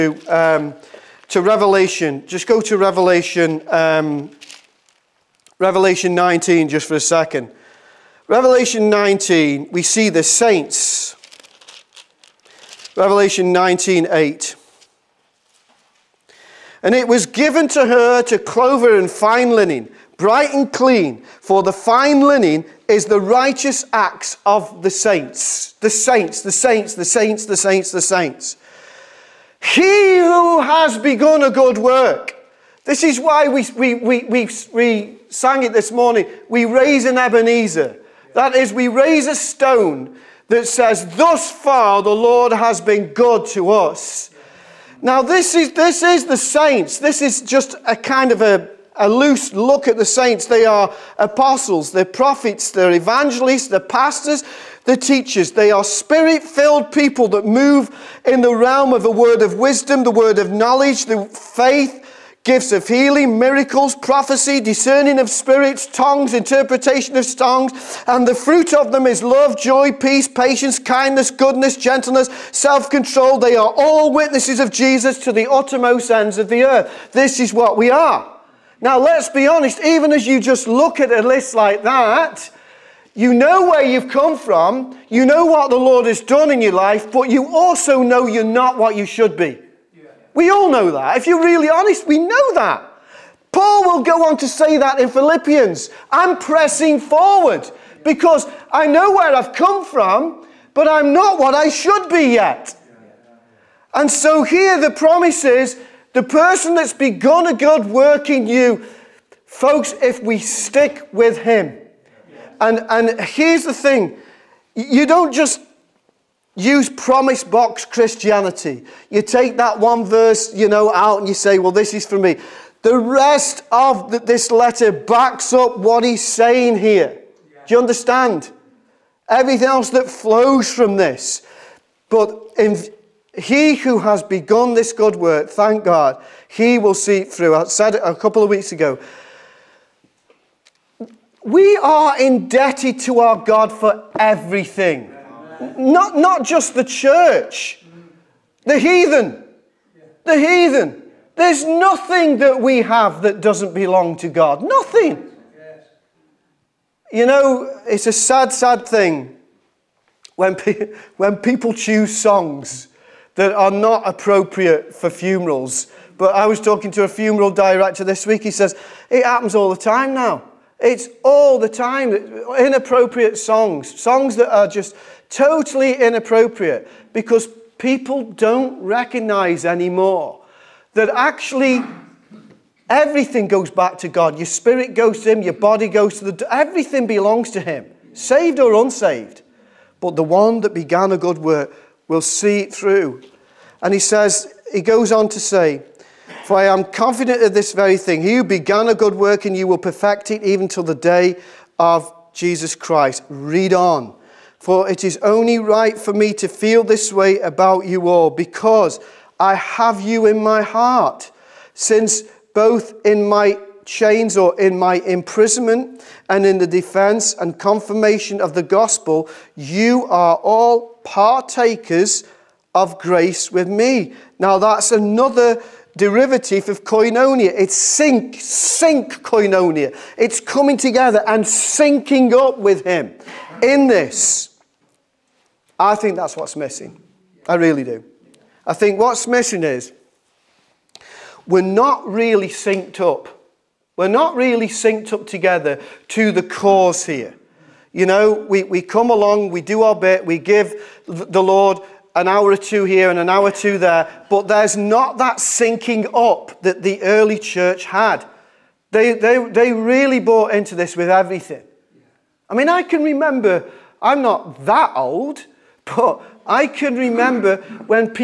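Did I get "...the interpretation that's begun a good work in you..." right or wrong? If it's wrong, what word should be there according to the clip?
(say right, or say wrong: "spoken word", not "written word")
wrong: "person", not "interpretation".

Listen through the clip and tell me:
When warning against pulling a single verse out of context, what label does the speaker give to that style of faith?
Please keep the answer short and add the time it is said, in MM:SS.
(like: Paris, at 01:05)
Promise box Christianity, at 01:56.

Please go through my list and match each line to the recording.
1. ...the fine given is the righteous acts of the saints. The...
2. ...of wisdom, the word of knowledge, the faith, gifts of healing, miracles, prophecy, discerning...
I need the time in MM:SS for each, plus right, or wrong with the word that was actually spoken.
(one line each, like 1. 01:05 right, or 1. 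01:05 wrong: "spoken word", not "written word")
1. 00:21 wrong: "linen", not "given"
2. 00:59 right.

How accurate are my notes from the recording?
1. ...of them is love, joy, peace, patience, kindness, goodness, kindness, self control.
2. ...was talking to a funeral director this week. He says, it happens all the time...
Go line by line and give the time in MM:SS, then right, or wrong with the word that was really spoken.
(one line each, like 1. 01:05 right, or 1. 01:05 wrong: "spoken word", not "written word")
1. 01:08 wrong: "gentleness", not "kindness"
2. 02:46 right.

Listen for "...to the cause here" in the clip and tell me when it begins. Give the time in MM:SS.
04:06.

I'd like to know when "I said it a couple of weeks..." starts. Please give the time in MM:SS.
02:17.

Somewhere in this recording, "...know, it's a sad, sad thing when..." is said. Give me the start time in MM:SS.
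02:37.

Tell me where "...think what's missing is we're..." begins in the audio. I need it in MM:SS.
03:58.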